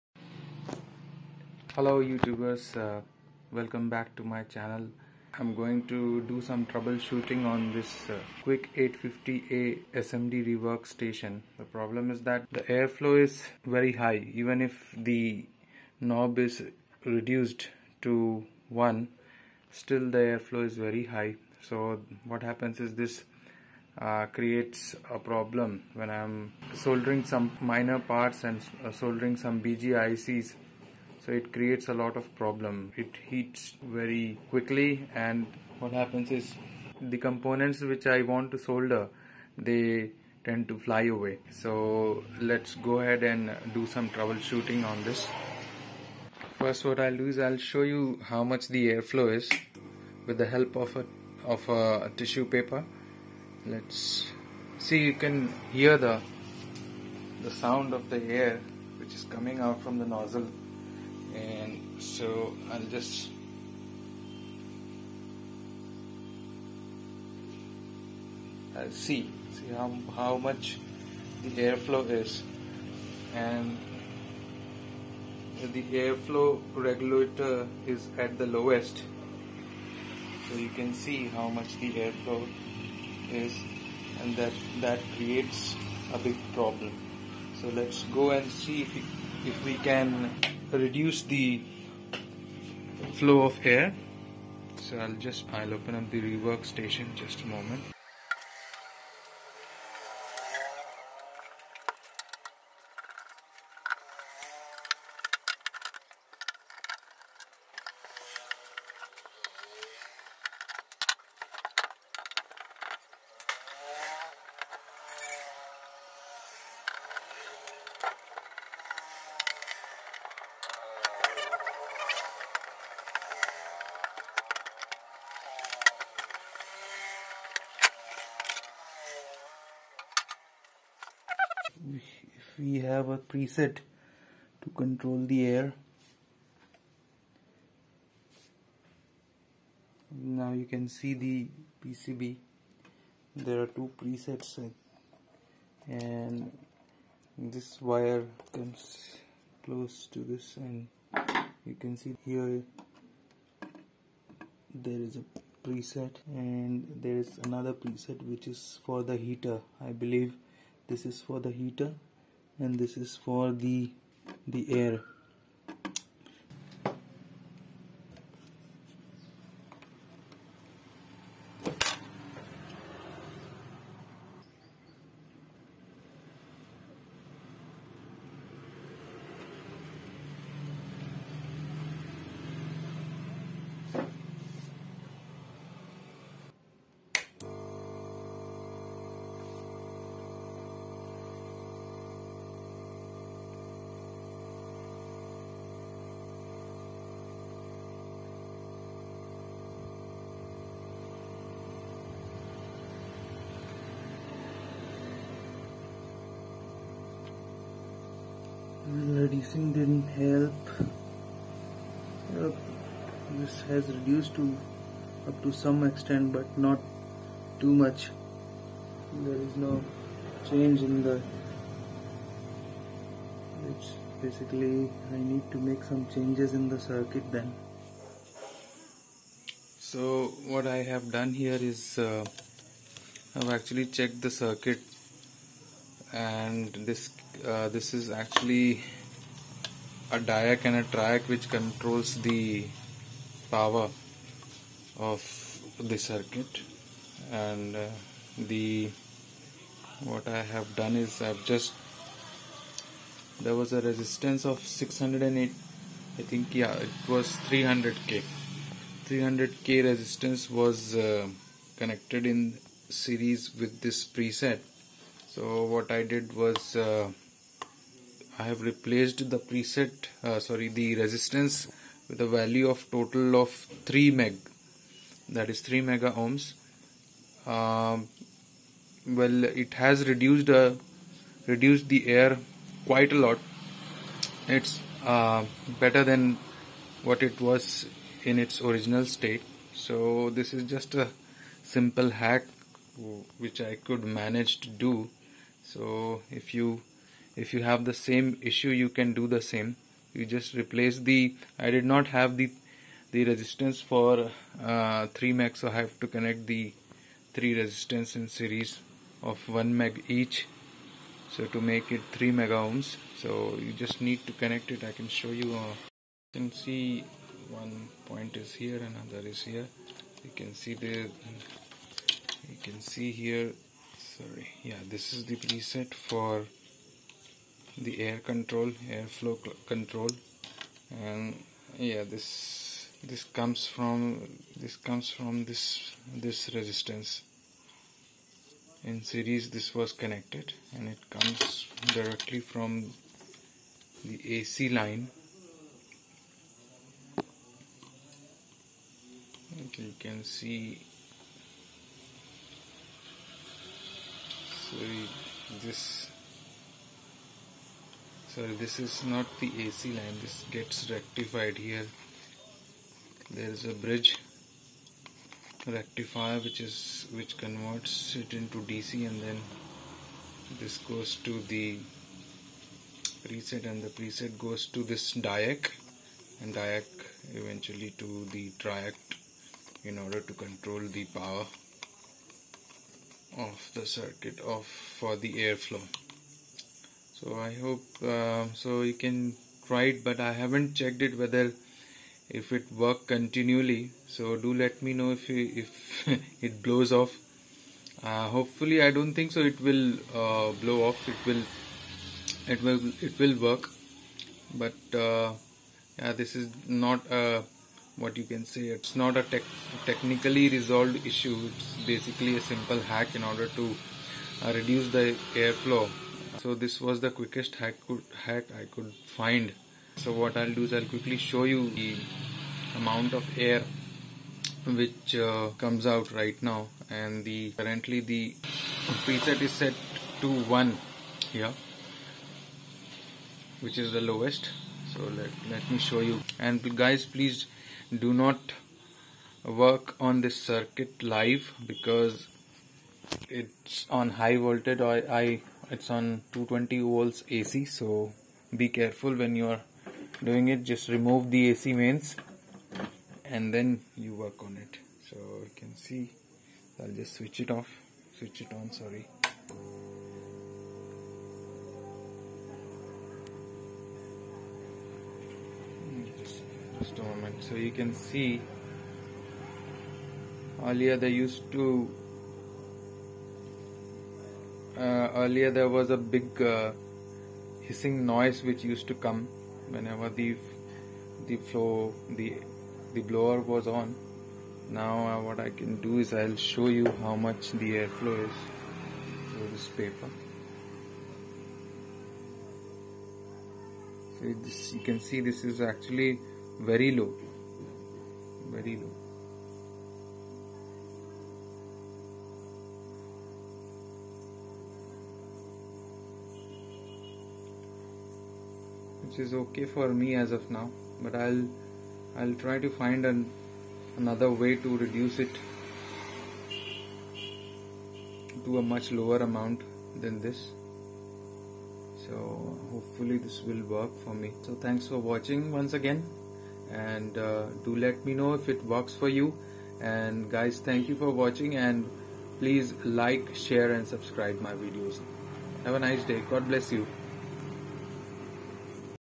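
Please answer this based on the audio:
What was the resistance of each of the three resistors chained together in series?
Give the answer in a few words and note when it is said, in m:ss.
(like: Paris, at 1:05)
1 meg, at 5:09.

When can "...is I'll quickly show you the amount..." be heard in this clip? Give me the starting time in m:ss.
7:00.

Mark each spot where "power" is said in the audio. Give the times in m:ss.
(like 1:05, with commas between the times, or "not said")
4:03, 6:21.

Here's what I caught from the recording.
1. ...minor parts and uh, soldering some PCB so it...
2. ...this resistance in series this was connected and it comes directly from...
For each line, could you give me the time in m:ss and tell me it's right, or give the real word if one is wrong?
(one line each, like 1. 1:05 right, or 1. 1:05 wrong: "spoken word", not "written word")
1. 0:27 wrong: "BGICs", not "PCB"
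2. 5:36 right.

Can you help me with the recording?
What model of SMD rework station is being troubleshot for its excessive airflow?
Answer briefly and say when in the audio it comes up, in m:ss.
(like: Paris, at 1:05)
Quick 850A, at 0:08.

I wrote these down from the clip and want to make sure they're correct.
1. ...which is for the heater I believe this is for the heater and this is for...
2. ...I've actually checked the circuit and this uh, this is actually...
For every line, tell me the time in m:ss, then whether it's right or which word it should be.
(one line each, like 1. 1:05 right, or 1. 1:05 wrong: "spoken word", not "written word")
1. 2:38 right
2. 3:53 right.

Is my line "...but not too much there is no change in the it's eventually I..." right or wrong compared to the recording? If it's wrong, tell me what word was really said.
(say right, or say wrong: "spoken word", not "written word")
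wrong: "basically", not "eventually".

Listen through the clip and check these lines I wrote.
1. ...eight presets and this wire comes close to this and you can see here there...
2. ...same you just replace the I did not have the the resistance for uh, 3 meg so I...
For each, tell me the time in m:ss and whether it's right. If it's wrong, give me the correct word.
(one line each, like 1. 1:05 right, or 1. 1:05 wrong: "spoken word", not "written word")
1. 2:23 wrong: "two", not "eight"
2. 4:59 right.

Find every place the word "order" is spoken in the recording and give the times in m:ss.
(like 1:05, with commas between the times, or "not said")
6:19, 6:53.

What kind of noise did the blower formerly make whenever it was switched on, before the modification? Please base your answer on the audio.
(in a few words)
Hissing noise.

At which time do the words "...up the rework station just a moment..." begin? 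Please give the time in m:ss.
1:35.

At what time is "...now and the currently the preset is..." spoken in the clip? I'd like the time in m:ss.
7:06.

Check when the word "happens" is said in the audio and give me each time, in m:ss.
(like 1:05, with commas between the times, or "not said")
0:22, 0:35.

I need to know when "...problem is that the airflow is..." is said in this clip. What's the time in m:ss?
0:11.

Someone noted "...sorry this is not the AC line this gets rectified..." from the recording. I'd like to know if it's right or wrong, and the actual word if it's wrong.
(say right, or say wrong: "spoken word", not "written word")
right.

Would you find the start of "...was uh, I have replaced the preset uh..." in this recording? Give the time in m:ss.
4:26.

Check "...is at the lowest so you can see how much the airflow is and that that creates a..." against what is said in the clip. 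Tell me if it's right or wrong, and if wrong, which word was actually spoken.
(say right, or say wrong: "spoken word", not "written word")
right.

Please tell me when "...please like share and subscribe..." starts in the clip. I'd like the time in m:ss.
8:52.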